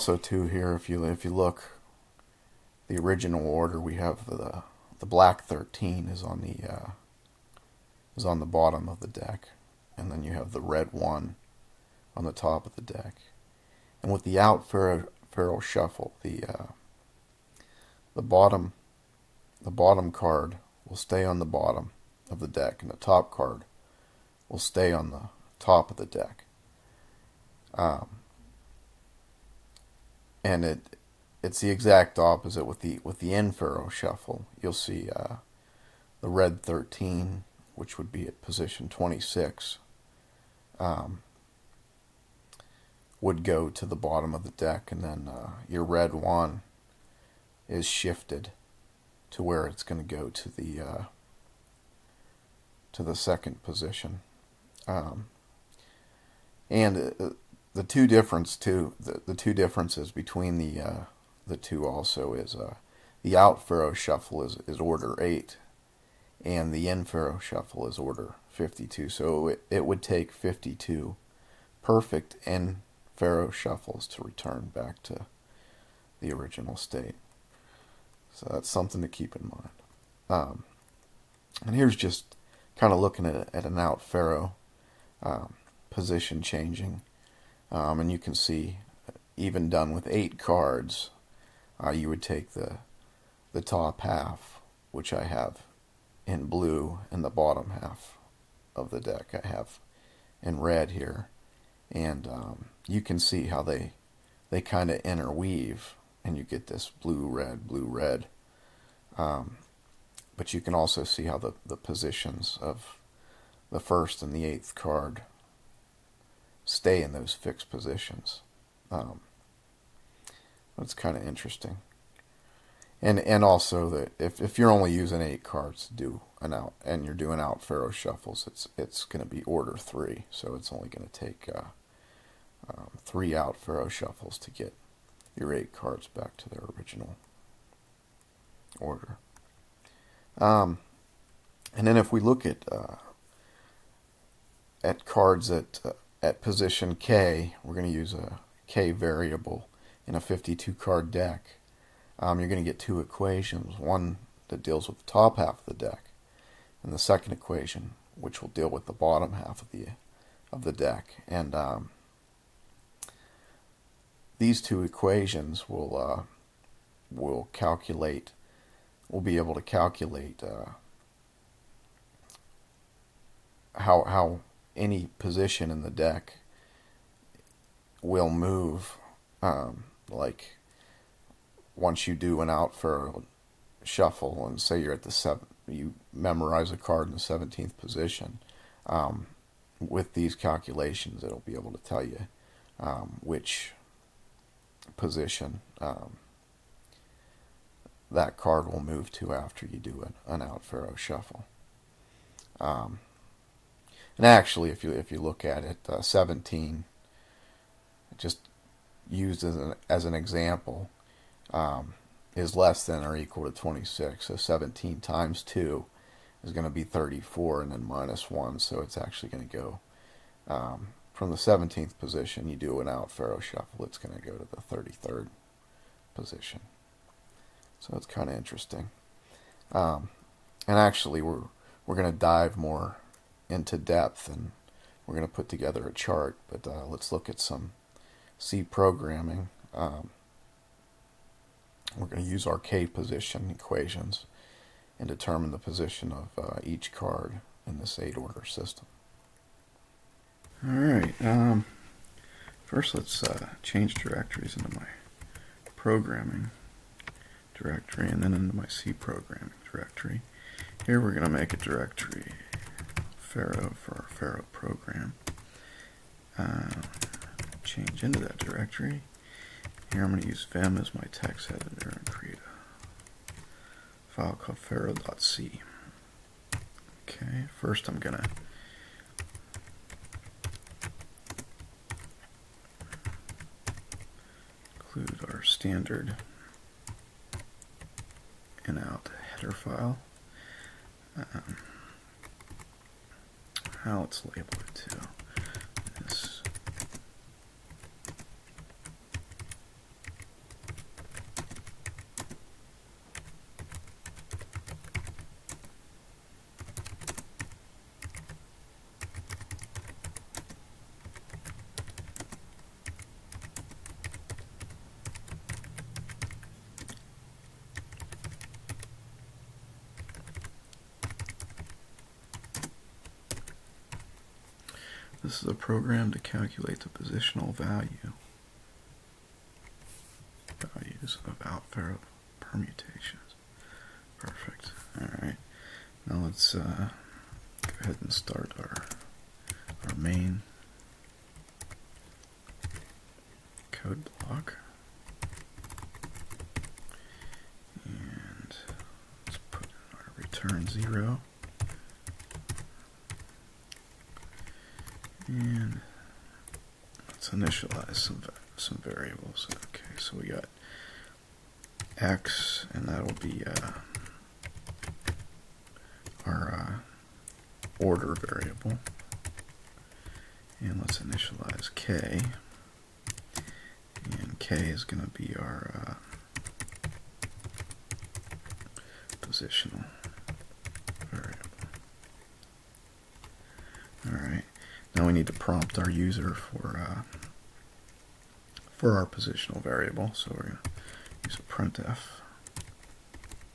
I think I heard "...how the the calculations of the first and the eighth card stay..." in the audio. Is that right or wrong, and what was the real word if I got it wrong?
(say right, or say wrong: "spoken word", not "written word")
wrong: "positions", not "calculations".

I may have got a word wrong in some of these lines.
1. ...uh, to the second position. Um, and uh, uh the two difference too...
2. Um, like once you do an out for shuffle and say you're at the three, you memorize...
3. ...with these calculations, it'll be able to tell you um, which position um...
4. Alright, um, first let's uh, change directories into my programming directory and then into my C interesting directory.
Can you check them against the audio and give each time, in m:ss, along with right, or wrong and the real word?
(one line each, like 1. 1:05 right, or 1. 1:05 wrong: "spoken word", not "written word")
1. 0:50 right
2. 2:59 wrong: "seven", not "three"
3. 3:09 right
4. 4:10 wrong: "programming", not "interesting".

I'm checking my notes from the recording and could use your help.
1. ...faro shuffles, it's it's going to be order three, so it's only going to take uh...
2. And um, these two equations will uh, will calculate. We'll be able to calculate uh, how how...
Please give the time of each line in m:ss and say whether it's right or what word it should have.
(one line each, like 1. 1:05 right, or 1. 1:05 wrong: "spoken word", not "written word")
1. 2:07 right
2. 2:41 right.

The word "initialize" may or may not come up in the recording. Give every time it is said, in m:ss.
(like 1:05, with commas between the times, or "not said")
5:57, 6:10.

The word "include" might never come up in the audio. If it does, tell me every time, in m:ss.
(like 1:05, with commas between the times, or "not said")
4:44.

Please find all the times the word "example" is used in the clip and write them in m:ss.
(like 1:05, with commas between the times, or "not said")
3:30.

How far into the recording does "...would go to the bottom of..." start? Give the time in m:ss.
0:43.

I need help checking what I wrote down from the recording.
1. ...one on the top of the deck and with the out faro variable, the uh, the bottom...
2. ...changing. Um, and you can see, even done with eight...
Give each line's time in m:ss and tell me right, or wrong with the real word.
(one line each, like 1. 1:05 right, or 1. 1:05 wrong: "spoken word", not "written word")
1. 0:10 wrong: "shuffle", not "variable"
2. 1:26 right.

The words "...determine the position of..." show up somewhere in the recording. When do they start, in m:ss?
4:05.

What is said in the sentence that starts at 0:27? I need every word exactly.
Um, and it it's the exact opposite with the with the in faro shuffle.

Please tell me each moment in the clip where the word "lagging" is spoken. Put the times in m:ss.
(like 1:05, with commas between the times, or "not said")
not said.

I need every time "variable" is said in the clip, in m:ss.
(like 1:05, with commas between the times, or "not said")
2:28, 5:58, 6:08, 6:21, 6:29.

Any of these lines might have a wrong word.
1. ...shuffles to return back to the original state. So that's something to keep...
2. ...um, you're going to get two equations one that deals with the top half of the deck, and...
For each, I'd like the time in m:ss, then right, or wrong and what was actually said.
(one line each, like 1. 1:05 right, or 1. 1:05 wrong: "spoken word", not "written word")
1. 1:13 right
2. 2:32 right.